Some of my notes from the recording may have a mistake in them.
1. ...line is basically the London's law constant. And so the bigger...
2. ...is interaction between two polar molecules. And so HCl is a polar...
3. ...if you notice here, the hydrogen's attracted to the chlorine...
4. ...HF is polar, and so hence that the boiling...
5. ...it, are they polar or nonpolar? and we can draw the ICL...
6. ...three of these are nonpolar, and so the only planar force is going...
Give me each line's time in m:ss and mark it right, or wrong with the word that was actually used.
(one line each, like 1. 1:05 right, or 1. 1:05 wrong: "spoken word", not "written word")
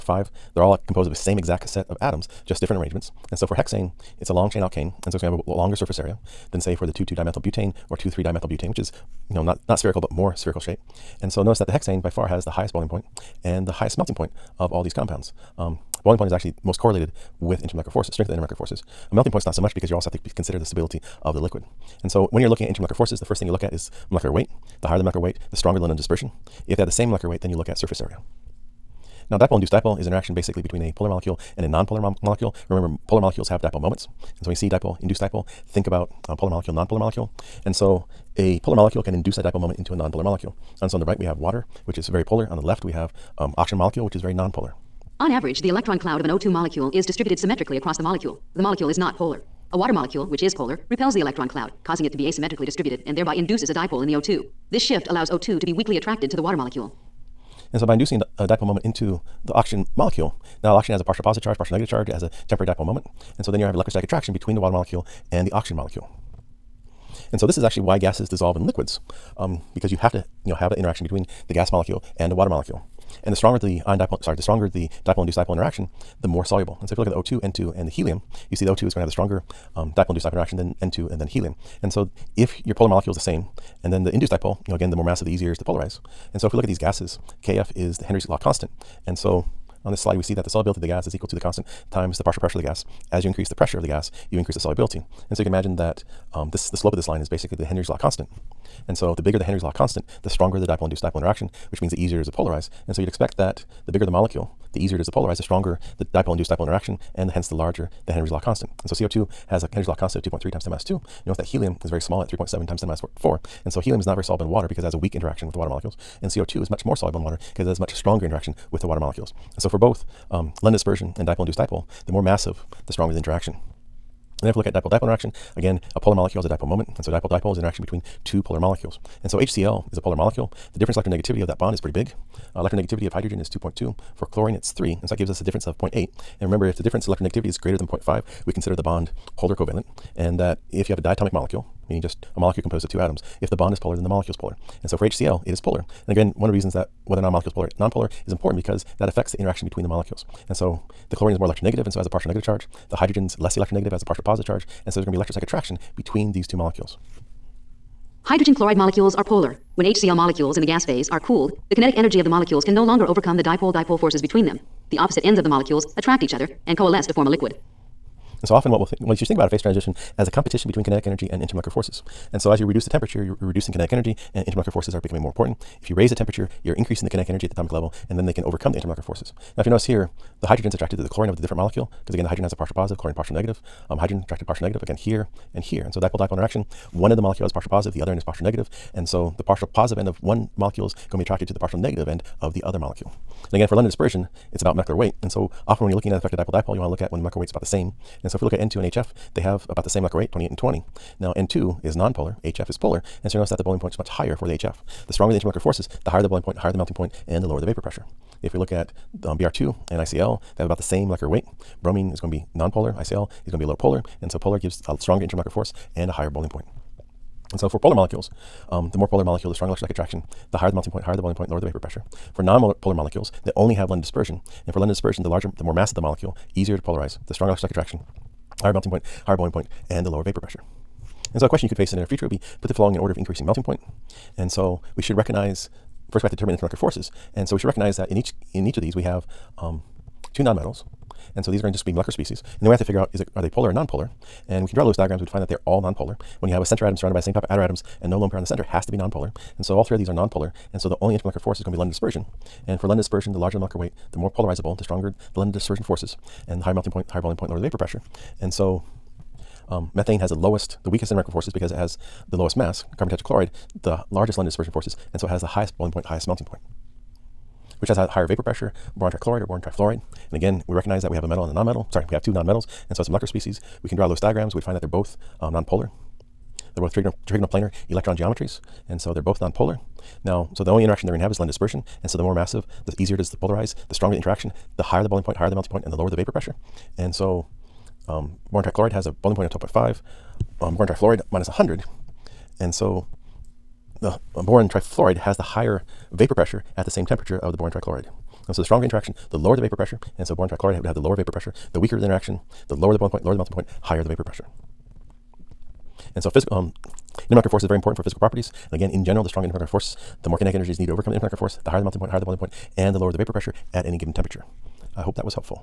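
1. 1:37 wrong: "Henry", not "London"
2. 2:07 right
3. 2:59 right
4. 3:22 wrong: "notice", not "hence"
5. 4:03 wrong: "Lewis", not "ICL"
6. 4:09 wrong: "intermolecular", not "planar".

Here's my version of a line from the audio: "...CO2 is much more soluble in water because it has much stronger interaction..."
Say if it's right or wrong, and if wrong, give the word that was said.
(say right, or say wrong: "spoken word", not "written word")
right.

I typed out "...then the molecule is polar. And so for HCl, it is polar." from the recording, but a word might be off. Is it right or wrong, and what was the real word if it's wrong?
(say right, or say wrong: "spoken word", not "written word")
right.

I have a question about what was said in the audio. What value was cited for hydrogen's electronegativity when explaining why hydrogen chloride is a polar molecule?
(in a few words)
2.2.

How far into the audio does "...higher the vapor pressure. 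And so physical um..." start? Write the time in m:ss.
5:03.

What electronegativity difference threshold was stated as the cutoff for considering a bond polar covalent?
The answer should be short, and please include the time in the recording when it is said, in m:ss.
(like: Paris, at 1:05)
0.5, at 2:17.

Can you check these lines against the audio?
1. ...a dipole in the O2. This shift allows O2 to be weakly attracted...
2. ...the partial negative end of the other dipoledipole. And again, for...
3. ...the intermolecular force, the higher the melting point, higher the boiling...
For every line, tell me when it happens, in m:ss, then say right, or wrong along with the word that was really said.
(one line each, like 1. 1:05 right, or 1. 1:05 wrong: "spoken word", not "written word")
1. 0:53 right
2. 3:11 wrong: "molecule", not "dipoledipole"
3. 5:11 right.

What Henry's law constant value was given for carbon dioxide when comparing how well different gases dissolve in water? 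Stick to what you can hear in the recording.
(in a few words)
2.3 x 10^-2.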